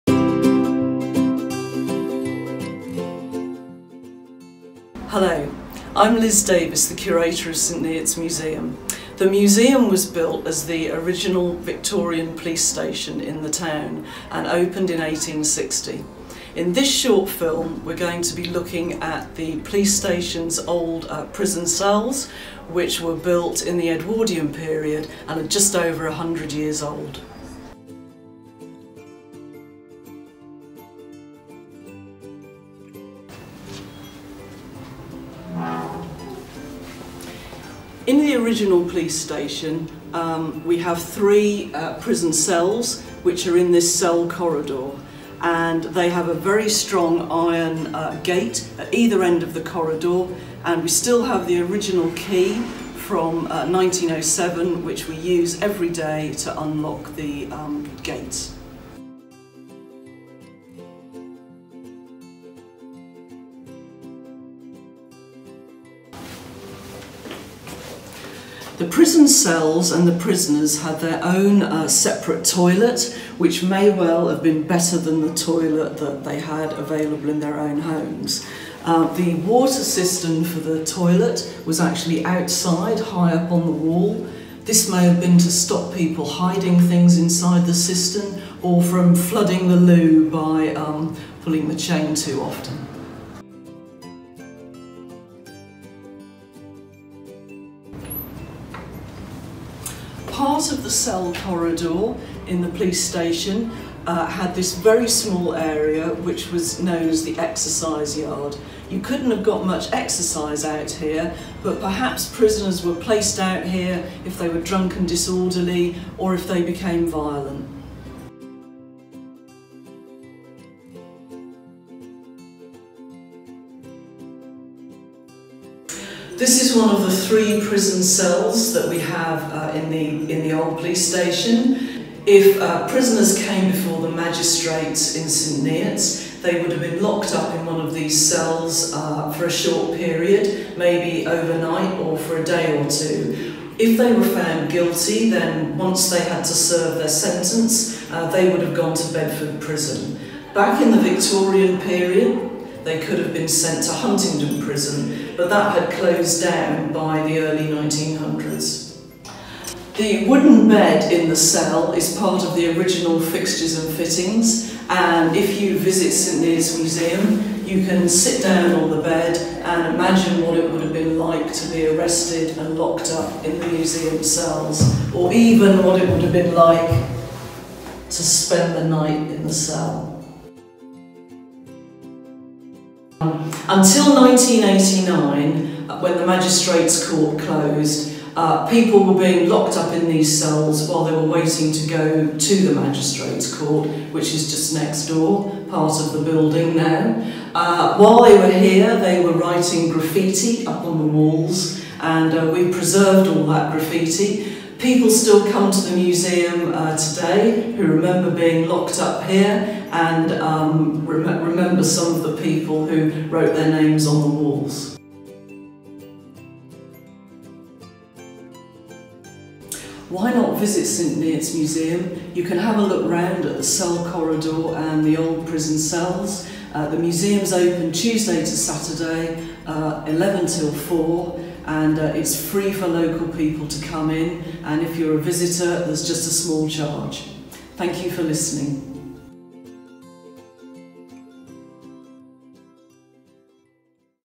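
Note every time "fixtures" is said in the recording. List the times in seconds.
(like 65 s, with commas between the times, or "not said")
163 s.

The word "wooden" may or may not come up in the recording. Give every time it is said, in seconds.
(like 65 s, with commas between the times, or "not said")
160 s.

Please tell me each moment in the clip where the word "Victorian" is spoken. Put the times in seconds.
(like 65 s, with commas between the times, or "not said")
11 s, 151 s.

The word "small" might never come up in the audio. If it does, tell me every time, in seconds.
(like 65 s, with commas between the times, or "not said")
105 s, 236 s.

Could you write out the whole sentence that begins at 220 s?
why not visit St Neots Museum?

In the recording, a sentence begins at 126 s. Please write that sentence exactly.
This is one of the three prison cells that we have uh, in, the, in the old police station.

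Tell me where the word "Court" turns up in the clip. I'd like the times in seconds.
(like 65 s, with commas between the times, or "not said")
187 s, 193 s.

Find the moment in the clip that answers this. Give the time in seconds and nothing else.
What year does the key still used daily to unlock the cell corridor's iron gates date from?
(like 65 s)
53 s.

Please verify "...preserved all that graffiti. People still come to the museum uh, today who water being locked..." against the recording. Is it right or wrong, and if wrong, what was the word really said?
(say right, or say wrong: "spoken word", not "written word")
wrong: "remember", not "water".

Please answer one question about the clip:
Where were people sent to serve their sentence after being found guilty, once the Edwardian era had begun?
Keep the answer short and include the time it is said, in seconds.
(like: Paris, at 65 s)
Bedford Prison, at 149 s.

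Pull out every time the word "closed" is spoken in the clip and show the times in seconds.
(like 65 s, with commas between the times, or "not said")
155 s, 187 s.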